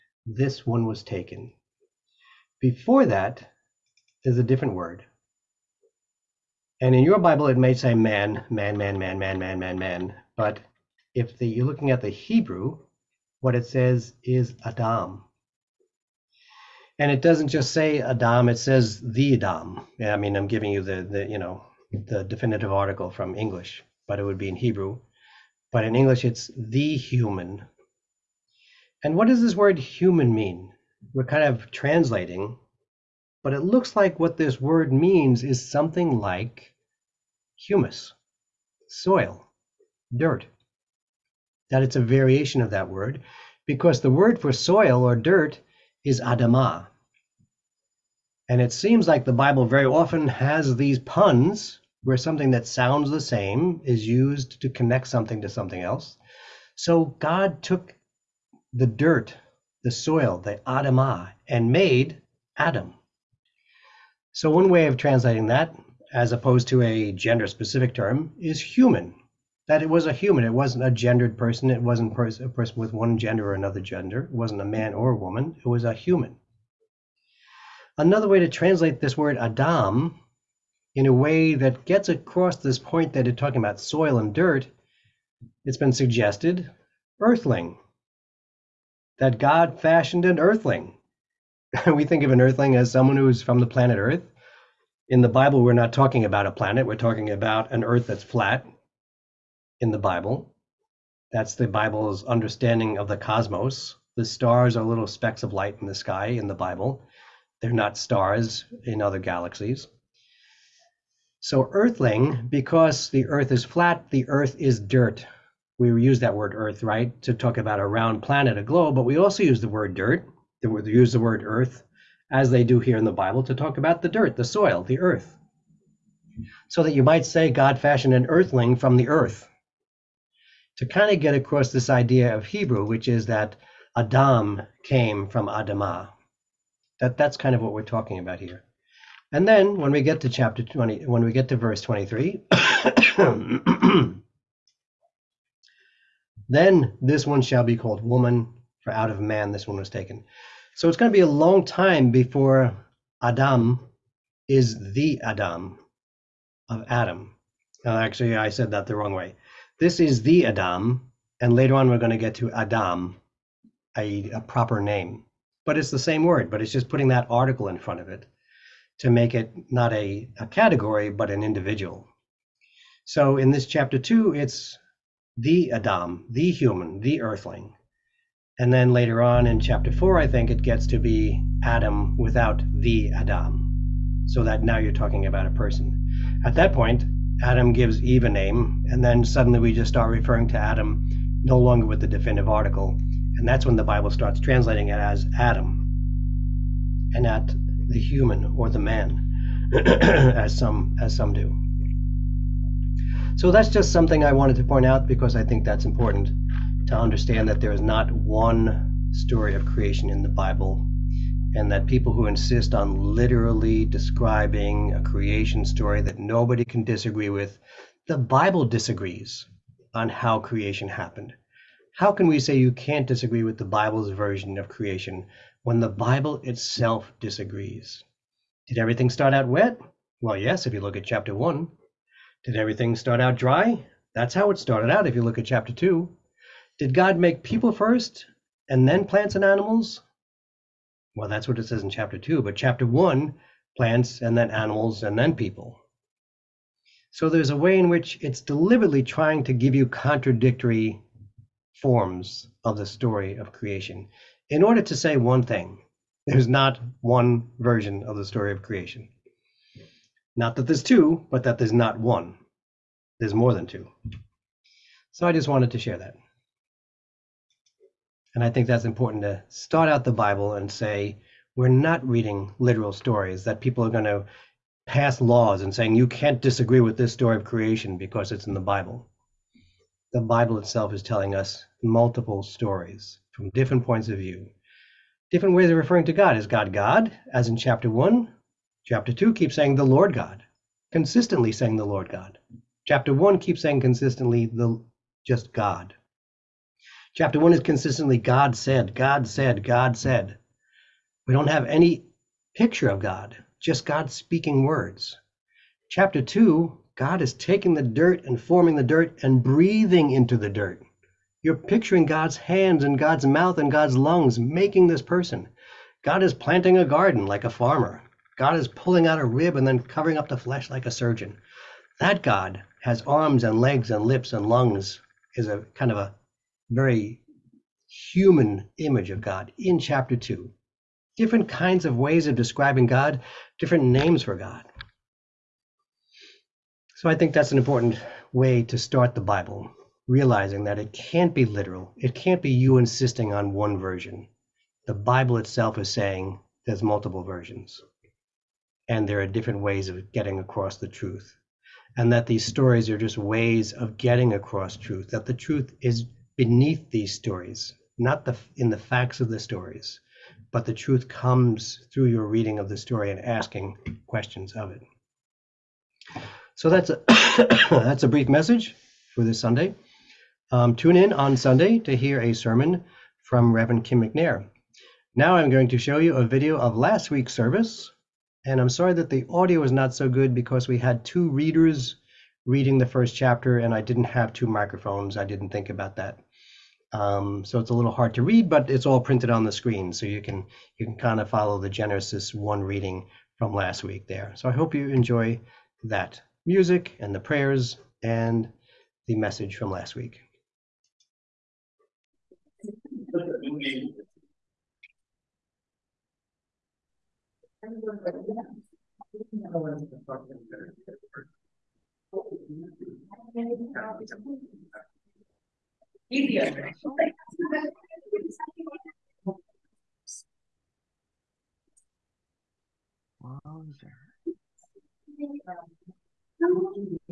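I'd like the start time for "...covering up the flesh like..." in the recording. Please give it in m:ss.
5:19.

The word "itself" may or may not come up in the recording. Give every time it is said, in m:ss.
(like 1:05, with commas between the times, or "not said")
3:46, 4:40, 5:45.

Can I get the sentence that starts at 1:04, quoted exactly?
So one way of translating that, as opposed to a gender specific term, is human.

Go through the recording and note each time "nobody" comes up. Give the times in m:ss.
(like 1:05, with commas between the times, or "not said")
3:36.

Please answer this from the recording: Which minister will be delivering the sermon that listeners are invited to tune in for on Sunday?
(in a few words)
Reverend Kim McNair.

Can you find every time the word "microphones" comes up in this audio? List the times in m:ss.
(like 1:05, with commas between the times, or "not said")
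6:24.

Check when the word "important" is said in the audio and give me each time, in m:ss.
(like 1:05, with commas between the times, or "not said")
3:25, 4:28, 5:37.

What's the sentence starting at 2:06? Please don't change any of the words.
So that you might say God fashioned an earthling from the earth.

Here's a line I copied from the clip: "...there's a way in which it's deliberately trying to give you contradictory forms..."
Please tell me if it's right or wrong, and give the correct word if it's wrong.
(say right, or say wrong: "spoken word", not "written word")
right.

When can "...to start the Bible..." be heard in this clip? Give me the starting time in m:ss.
5:38.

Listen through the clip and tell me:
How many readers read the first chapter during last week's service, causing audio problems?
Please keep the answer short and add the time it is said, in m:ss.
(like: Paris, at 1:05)
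2, at 6:21.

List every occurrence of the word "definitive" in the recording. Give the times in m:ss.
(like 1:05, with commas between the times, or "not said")
0:22, 3:12.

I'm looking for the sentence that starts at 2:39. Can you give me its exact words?
This is the Adam, and later on we're going to get to Adam, a, a proper name.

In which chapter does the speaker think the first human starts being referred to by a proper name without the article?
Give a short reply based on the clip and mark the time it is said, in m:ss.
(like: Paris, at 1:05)
chapter four, at 2:59.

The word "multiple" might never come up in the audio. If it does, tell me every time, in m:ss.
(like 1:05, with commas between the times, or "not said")
4:41, 5:46.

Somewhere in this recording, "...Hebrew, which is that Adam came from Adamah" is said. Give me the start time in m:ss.
2:12.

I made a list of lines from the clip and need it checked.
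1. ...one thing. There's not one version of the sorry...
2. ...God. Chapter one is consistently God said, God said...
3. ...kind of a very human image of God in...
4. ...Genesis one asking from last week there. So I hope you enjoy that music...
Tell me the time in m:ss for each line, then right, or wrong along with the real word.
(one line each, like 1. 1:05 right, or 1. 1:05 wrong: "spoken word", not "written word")
1. 4:15 wrong: "story", not "sorry"
2. 4:55 right
3. 5:25 right
4. 6:31 wrong: "reading", not "asking".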